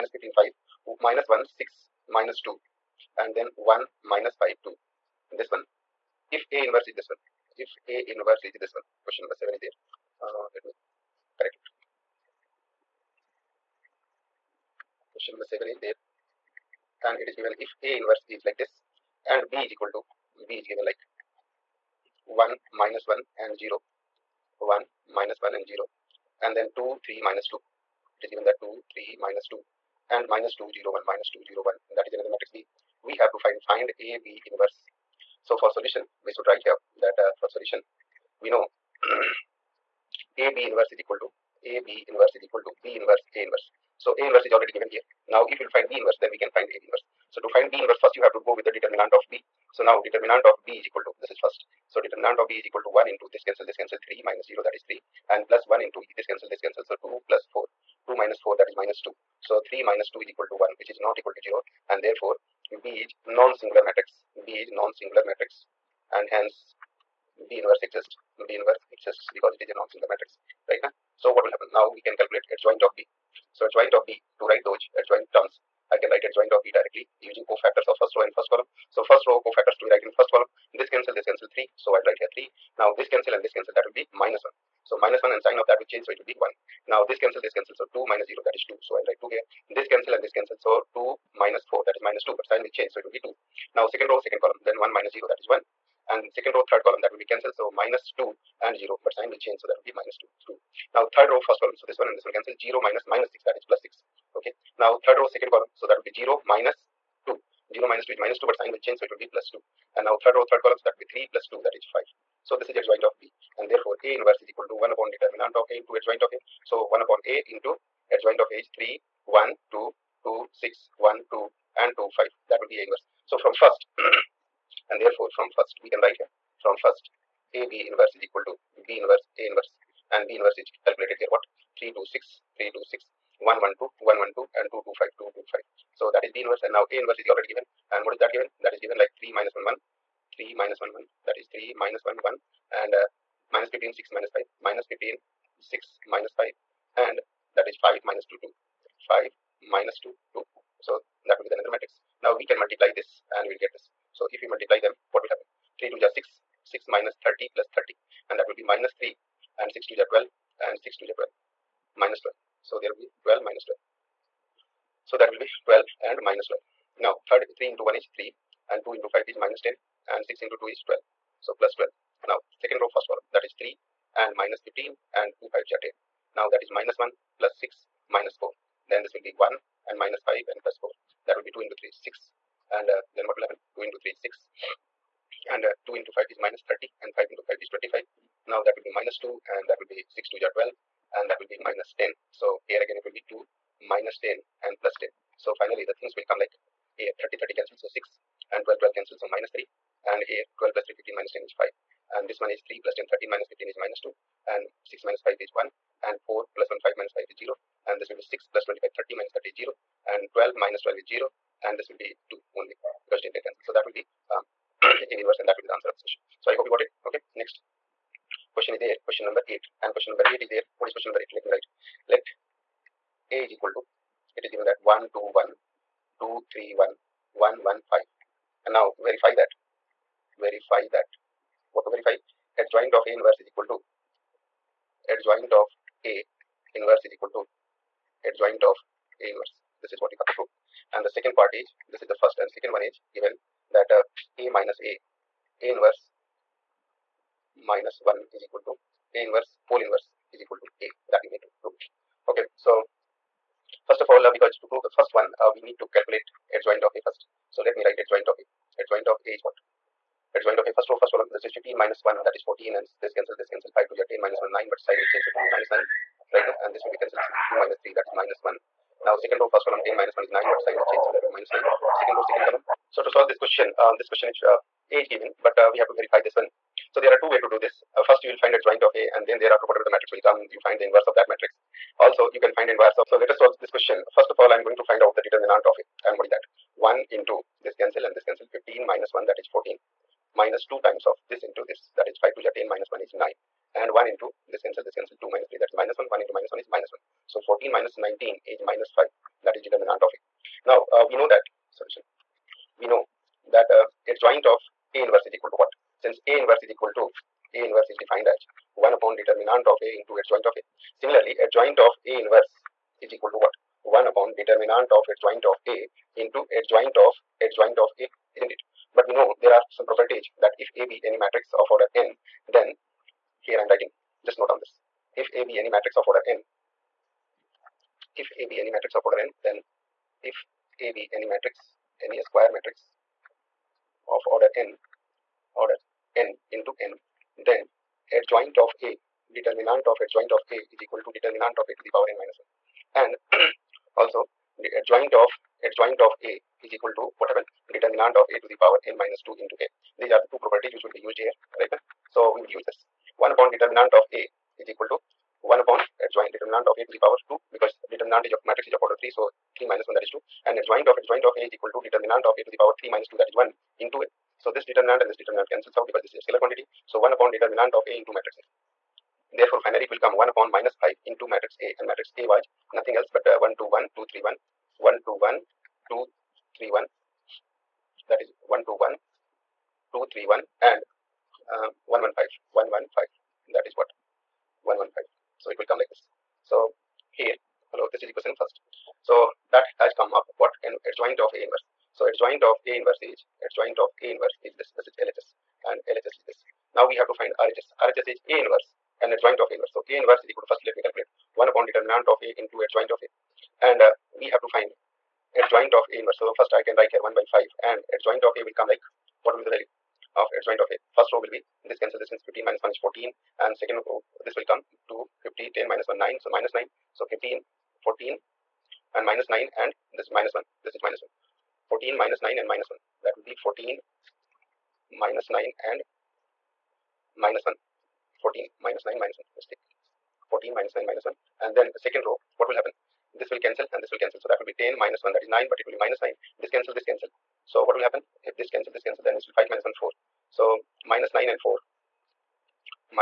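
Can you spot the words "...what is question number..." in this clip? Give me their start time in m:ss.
3:40.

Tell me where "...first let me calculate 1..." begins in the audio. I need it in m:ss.
6:40.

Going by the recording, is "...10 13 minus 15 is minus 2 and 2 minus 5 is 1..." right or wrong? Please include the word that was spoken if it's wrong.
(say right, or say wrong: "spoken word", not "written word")
wrong: "6", not "2".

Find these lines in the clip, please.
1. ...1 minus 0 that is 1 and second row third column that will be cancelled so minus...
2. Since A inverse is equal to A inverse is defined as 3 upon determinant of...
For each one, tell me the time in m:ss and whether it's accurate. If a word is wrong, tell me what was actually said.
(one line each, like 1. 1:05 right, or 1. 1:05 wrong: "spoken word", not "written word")
1. 1:34 right
2. 5:05 wrong: "1", not "3".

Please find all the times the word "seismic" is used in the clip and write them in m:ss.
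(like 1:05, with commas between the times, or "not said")
not said.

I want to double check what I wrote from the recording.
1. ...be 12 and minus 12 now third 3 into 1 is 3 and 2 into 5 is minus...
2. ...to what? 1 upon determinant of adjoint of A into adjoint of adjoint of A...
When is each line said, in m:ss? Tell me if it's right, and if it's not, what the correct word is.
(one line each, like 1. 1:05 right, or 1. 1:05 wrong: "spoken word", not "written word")
1. 2:45 right
2. 5:13 right.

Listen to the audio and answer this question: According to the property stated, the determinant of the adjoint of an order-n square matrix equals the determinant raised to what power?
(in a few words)
n minus 1.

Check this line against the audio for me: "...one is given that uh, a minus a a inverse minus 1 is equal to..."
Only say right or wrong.
right.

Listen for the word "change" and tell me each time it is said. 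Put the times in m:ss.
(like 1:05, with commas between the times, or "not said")
1:25, 1:32, 1:39, 1:48, 4:25, 4:30.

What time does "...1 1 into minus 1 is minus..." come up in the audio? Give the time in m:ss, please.
4:55.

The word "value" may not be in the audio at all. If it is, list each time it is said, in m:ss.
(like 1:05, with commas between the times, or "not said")
6:49.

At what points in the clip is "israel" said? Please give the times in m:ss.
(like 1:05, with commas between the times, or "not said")
not said.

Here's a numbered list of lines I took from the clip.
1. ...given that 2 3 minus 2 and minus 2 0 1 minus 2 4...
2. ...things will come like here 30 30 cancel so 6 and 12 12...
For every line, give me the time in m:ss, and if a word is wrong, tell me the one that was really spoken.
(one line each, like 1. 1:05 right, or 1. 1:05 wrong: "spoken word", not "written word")
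1. 0:28 wrong: "0", not "4"
2. 3:15 right.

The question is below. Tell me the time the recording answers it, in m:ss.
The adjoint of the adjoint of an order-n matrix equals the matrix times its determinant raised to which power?
5:48.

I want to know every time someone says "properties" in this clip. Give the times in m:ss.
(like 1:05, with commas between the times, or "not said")
5:19, 5:50.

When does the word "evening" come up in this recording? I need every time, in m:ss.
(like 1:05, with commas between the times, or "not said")
not said.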